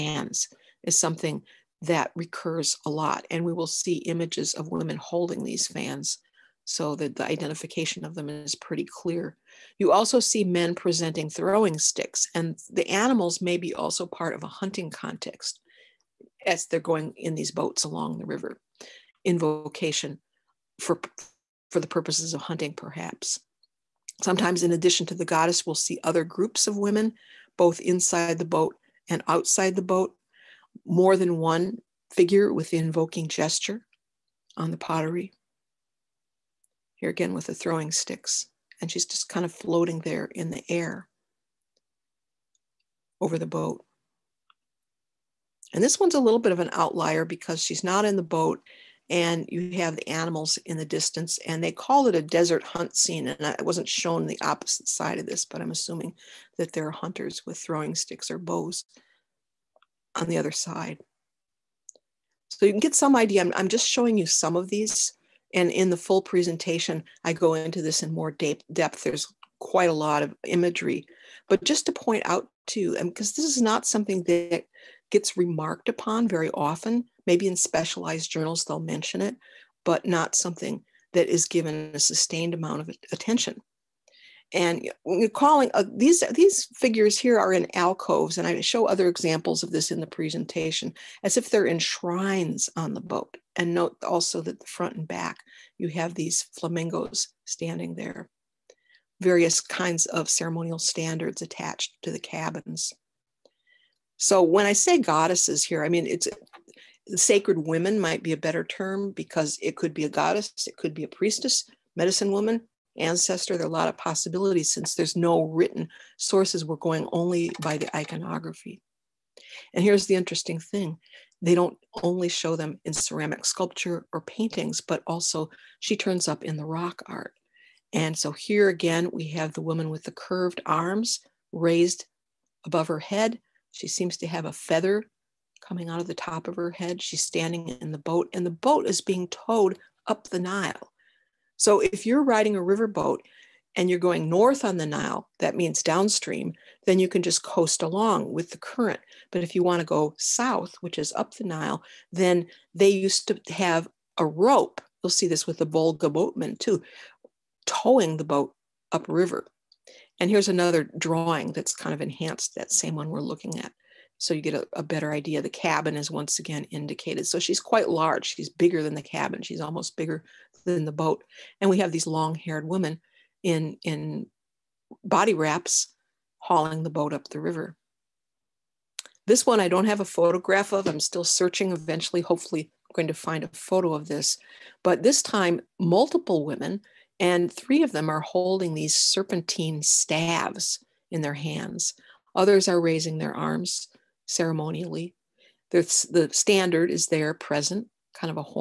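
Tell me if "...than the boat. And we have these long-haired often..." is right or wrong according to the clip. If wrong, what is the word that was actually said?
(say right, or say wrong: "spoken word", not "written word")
wrong: "women", not "often".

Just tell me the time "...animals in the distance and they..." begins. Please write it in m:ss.
0:50.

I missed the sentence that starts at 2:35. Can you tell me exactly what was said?
You'll see this with the Volga boatmen too, towing the boat upriver.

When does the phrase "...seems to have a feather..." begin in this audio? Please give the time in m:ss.
2:13.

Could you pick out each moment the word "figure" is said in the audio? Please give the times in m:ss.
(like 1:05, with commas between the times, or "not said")
0:32, 1:26.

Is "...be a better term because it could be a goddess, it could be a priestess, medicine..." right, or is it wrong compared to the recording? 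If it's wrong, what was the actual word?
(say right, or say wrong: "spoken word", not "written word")
right.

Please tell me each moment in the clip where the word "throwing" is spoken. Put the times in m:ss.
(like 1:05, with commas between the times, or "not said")
0:11, 0:37, 0:57.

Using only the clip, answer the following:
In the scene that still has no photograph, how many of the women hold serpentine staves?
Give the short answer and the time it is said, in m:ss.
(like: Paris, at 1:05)
3, at 3:07.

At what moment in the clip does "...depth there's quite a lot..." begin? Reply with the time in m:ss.
1:08.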